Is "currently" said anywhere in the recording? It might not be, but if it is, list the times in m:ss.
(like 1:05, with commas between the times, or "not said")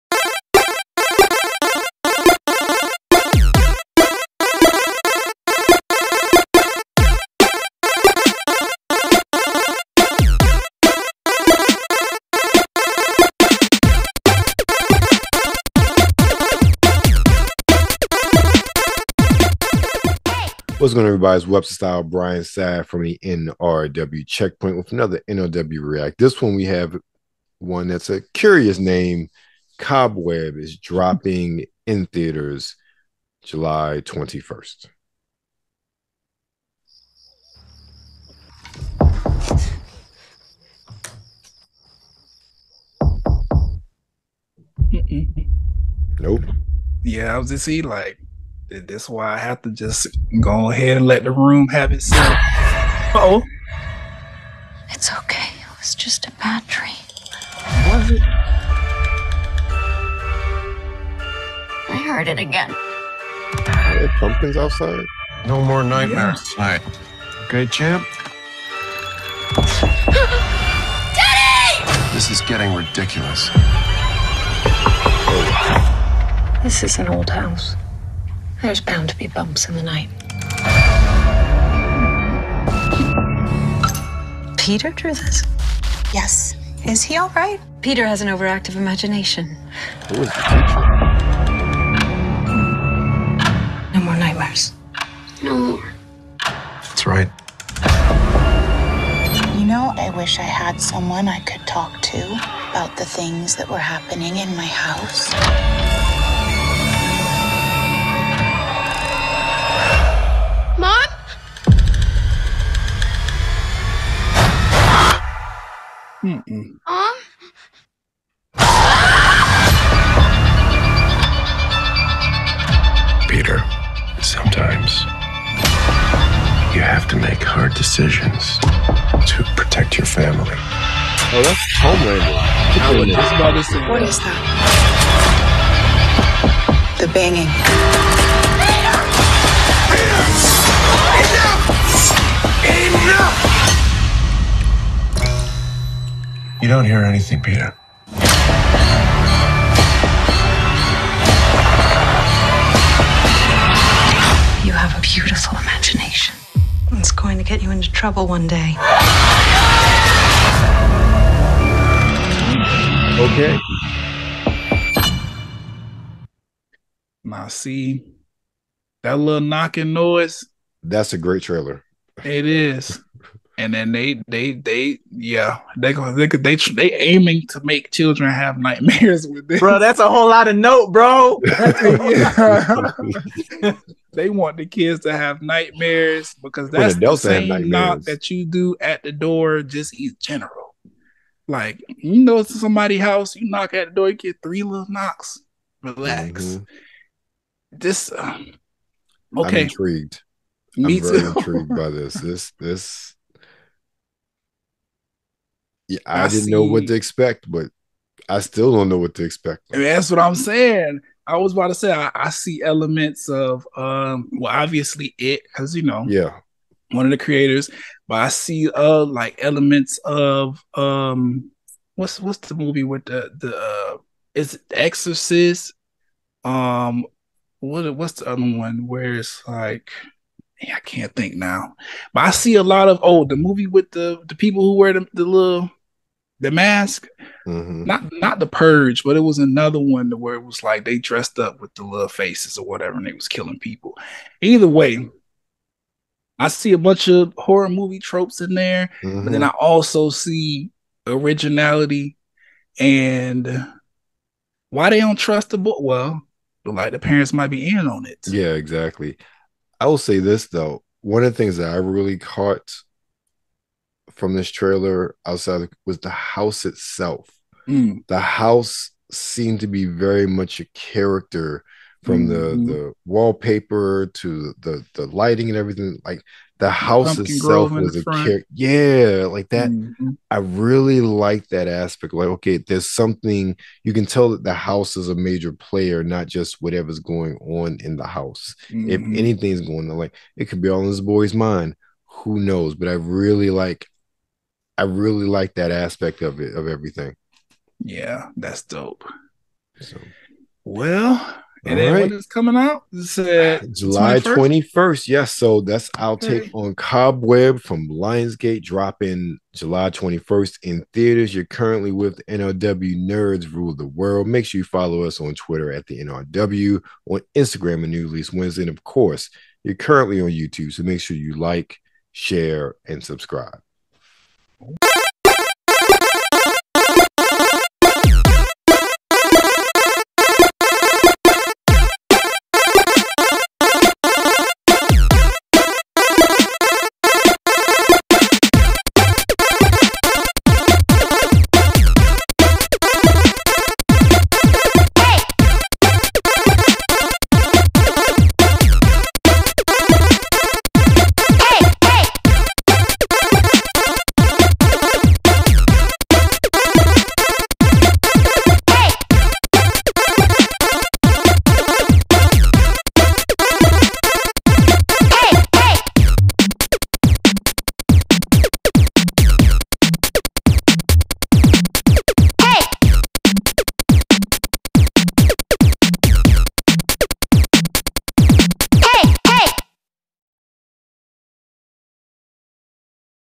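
5:11, 5:19.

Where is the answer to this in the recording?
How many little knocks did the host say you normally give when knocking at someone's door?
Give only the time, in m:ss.
3:14.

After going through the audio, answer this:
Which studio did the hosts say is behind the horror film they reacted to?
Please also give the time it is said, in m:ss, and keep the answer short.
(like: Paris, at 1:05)
Lionsgate, at 5:07.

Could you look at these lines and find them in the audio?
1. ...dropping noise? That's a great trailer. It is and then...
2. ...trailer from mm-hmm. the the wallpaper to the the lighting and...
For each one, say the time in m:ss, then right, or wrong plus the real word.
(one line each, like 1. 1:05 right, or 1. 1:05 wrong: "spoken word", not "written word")
1. 2:49 wrong: "knocking", not "dropping"
2. 4:30 wrong: "character", not "trailer".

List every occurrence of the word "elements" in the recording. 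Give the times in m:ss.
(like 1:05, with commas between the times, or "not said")
3:32, 3:39.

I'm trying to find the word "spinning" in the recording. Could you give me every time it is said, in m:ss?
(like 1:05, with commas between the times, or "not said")
not said.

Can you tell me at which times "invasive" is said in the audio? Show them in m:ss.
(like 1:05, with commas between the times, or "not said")
not said.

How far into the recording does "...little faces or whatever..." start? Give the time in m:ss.
4:01.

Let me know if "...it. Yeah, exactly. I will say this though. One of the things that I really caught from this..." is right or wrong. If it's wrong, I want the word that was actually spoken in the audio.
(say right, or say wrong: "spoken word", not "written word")
right.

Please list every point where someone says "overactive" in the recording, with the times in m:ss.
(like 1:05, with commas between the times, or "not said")
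1:28.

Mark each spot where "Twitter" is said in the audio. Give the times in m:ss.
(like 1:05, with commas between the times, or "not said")
5:15.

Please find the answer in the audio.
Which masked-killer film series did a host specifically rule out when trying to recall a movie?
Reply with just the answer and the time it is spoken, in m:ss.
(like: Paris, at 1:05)
The Purge, at 3:58.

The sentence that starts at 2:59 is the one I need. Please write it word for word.
Bro, that's a whole lot of note, bro.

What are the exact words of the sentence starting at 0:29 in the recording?
Cobweb is dropping in theaters July 21st.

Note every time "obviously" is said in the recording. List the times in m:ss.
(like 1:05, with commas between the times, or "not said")
3:34.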